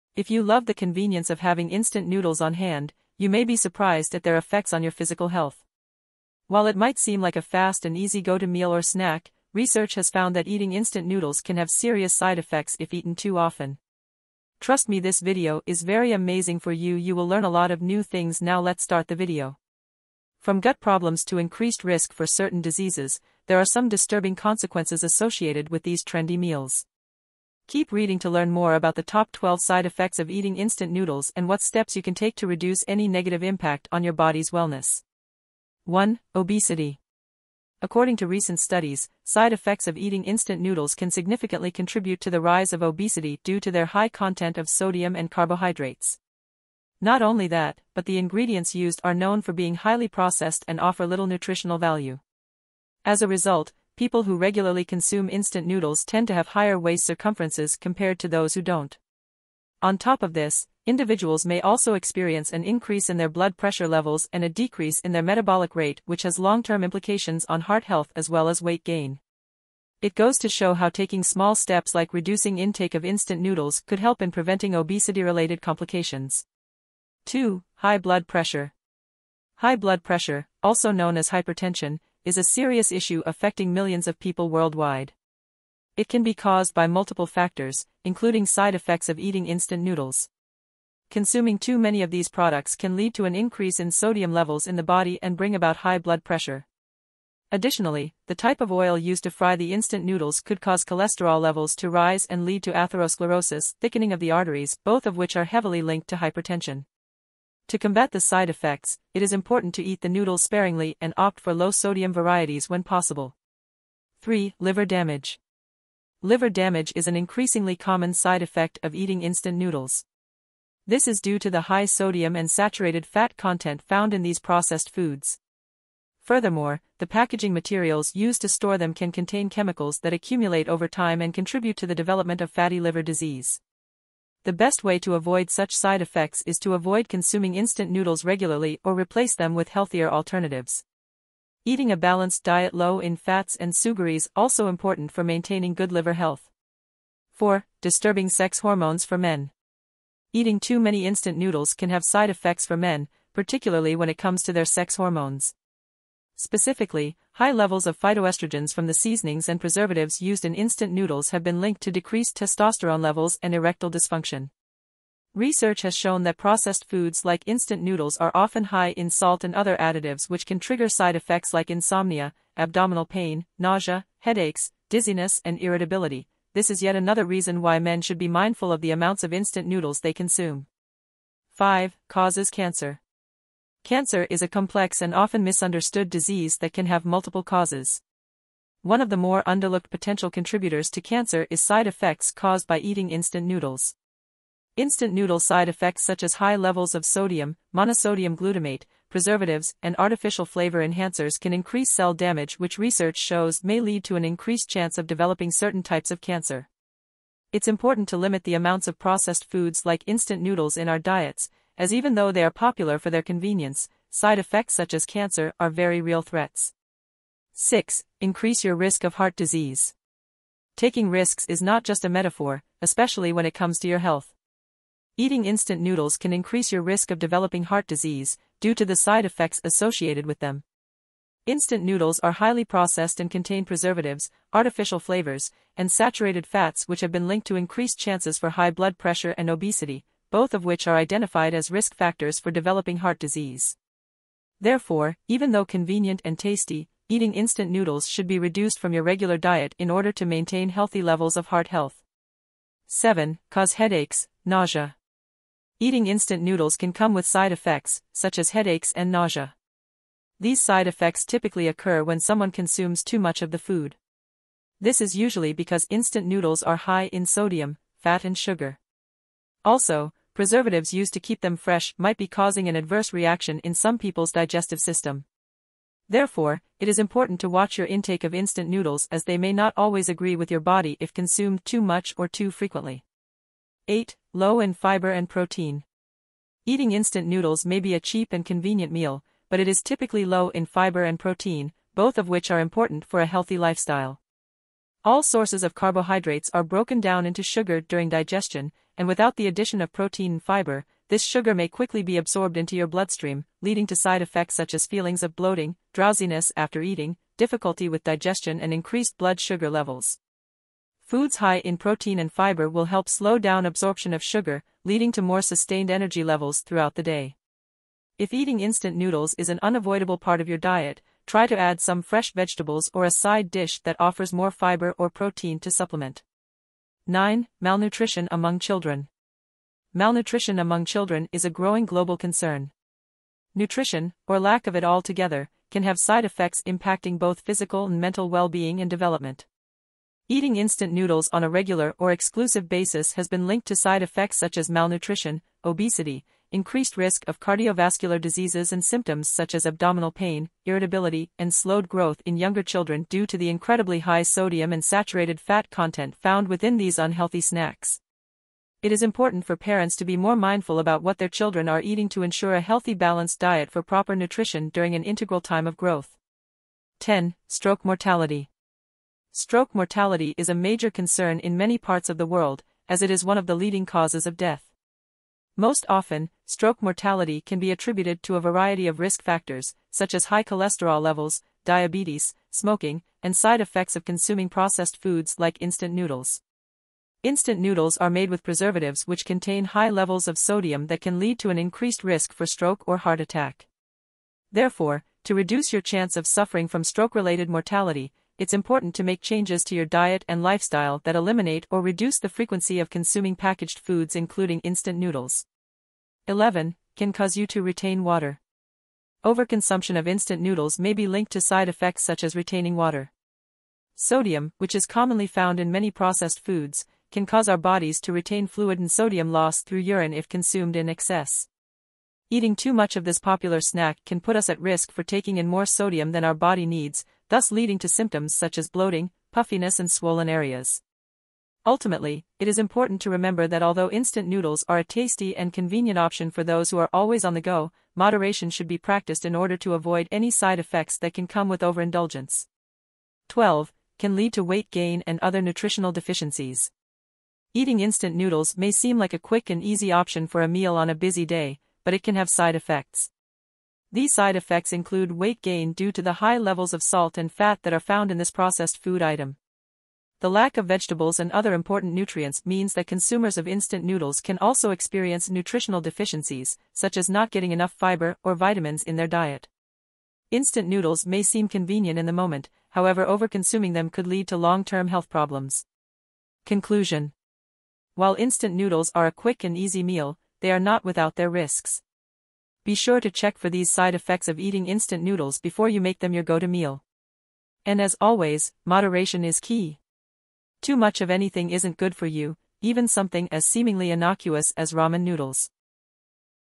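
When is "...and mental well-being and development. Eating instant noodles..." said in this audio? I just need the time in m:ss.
5:37.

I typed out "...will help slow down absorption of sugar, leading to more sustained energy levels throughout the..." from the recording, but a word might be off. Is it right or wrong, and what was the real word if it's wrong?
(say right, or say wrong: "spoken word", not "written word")
right.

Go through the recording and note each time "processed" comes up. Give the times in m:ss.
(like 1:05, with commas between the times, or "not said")
0:50, 2:04, 2:46, 3:28, 3:52, 6:24, 6:55, 7:38.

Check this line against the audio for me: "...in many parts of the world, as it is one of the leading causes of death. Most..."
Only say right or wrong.
right.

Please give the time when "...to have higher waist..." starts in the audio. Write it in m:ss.
0:56.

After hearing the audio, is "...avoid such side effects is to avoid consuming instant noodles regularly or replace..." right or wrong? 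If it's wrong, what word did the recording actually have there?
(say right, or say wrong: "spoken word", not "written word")
right.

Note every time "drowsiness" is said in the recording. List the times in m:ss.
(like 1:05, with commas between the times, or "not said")
5:05.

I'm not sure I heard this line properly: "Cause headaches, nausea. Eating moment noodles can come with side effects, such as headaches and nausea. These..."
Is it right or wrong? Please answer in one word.
wrong.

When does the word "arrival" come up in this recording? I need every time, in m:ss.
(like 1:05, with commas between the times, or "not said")
not said.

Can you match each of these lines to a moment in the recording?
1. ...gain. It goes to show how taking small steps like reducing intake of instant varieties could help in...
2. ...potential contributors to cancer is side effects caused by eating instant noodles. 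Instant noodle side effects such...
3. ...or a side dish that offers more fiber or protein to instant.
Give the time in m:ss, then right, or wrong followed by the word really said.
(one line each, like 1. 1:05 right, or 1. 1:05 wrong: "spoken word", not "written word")
1. 1:08 wrong: "noodles", not "varieties"
2. 3:09 right
3. 5:22 wrong: "supplement", not "instant".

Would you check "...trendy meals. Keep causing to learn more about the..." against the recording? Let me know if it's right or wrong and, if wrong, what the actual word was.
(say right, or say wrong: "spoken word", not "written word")
wrong: "reading", not "causing".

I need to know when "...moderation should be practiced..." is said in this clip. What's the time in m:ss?
7:17.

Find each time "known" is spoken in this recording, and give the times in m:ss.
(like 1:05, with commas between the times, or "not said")
0:49, 1:20.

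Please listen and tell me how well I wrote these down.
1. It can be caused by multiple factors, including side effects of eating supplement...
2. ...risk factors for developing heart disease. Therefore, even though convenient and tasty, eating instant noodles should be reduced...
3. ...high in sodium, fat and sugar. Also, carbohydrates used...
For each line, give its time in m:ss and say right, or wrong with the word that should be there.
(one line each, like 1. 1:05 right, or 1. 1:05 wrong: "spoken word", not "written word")
1. 1:25 wrong: "instant", not "supplement"
2. 4:01 right
3. 4:26 wrong: "preservatives", not "carbohydrates".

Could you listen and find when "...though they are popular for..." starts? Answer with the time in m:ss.
3:32.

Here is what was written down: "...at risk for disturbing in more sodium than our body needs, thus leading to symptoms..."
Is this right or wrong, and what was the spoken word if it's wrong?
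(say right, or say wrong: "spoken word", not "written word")
wrong: "taking", not "disturbing".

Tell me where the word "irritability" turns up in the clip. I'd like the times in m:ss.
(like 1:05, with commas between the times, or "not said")
2:55, 5:50.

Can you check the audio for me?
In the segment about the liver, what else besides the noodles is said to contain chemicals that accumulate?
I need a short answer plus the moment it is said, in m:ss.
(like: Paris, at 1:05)
packaging materials, at 2:07.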